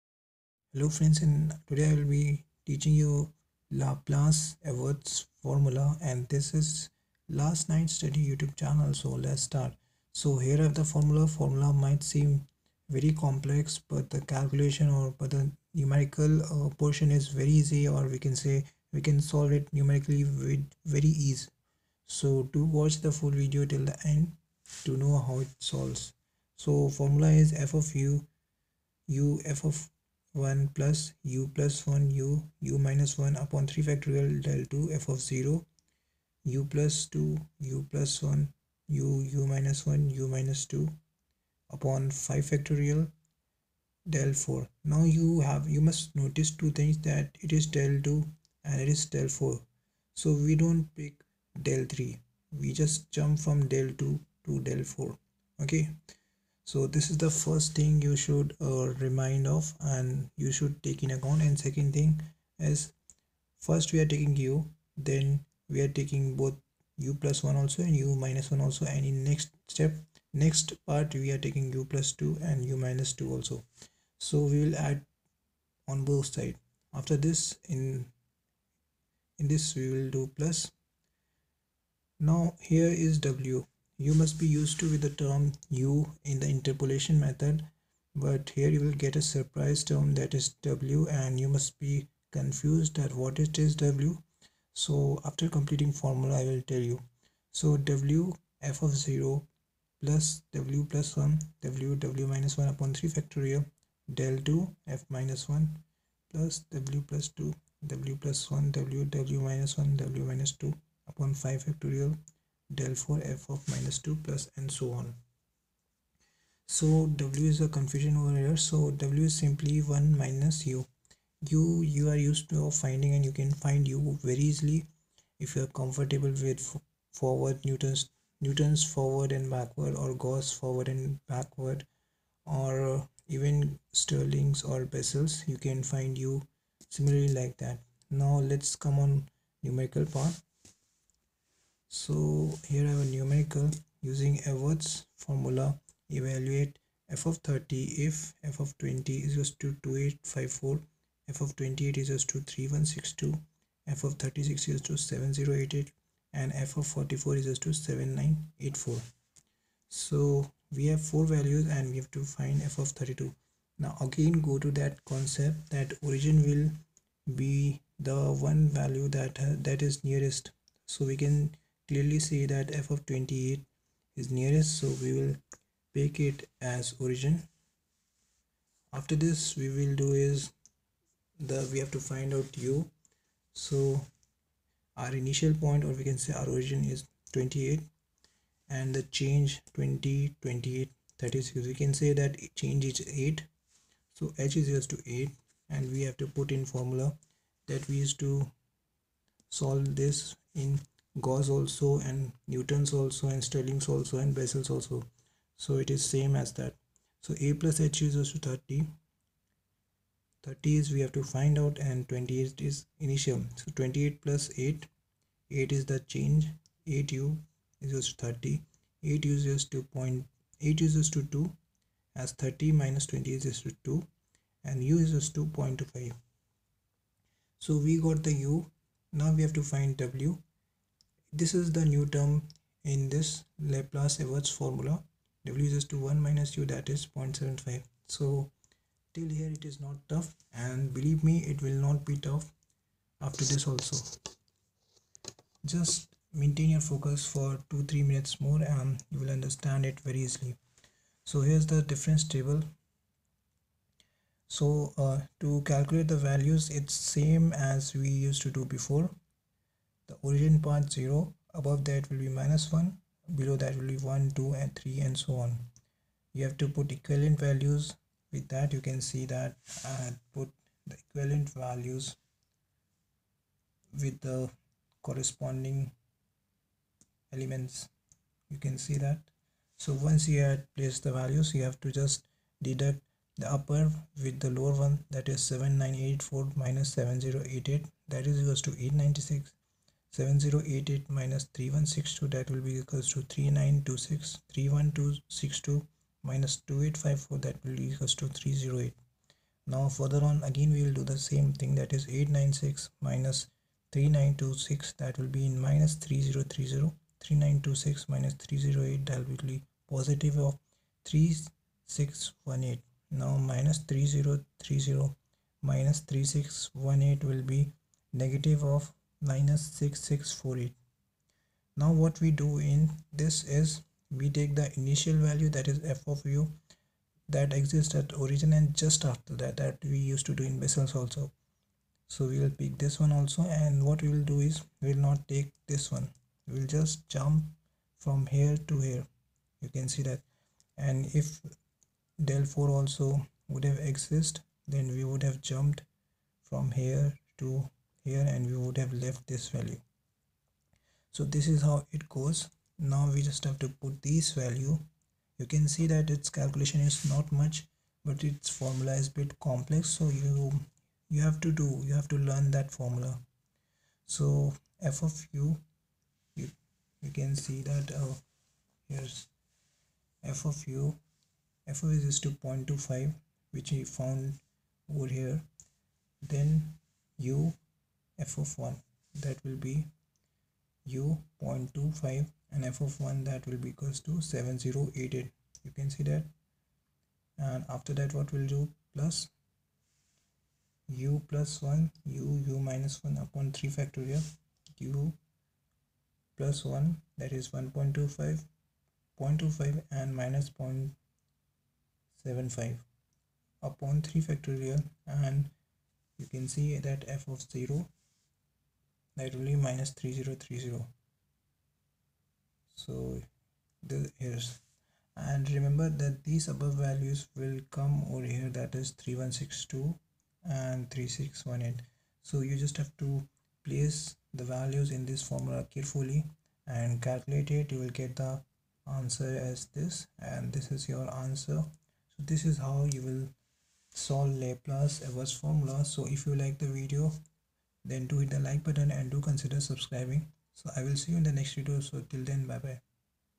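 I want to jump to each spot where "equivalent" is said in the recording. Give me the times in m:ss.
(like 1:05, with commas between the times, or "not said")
4:26, 4:31.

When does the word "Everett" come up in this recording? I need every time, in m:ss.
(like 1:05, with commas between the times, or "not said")
0:04, 2:24, 3:54, 7:15.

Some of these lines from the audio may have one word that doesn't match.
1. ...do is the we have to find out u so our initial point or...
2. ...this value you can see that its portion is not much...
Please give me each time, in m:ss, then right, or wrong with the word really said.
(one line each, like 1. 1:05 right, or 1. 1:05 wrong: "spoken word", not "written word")
1. 3:00 right
2. 5:54 wrong: "calculation", not "portion".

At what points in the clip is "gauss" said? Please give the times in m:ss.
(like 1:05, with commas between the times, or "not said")
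2:10, 3:21.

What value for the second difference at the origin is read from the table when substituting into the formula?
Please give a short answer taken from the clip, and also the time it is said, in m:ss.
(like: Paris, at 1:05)
-3030, at 6:49.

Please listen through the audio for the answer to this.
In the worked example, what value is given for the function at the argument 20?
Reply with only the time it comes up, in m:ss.
2:29.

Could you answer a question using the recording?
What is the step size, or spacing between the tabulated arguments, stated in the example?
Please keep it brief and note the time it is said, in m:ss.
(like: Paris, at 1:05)
8, at 3:14.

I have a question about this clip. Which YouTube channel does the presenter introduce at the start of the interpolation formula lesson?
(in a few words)
Last Night Study.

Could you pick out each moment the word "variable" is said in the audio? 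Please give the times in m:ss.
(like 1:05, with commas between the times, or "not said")
not said.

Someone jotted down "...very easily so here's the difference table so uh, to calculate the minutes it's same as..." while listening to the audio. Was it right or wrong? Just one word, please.
wrong.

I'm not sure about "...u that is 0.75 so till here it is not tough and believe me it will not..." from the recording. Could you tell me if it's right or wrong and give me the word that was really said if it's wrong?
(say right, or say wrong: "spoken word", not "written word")
right.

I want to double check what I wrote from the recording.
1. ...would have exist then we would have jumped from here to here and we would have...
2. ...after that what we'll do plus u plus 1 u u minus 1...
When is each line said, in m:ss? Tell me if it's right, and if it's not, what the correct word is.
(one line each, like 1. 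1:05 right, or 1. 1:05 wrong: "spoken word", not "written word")
1. 5:43 right
2. 6:27 right.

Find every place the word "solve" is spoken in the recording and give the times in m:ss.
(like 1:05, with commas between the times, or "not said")
0:19, 0:25, 3:19, 7:13.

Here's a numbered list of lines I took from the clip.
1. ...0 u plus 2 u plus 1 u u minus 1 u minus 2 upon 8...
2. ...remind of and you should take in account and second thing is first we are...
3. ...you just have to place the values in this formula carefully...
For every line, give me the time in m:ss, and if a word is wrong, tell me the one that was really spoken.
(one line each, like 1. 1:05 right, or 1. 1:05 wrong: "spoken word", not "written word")
1. 0:35 wrong: "5", not "8"
2. 0:59 right
3. 7:02 right.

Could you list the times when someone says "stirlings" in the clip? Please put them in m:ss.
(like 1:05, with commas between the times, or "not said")
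2:14, 3:23.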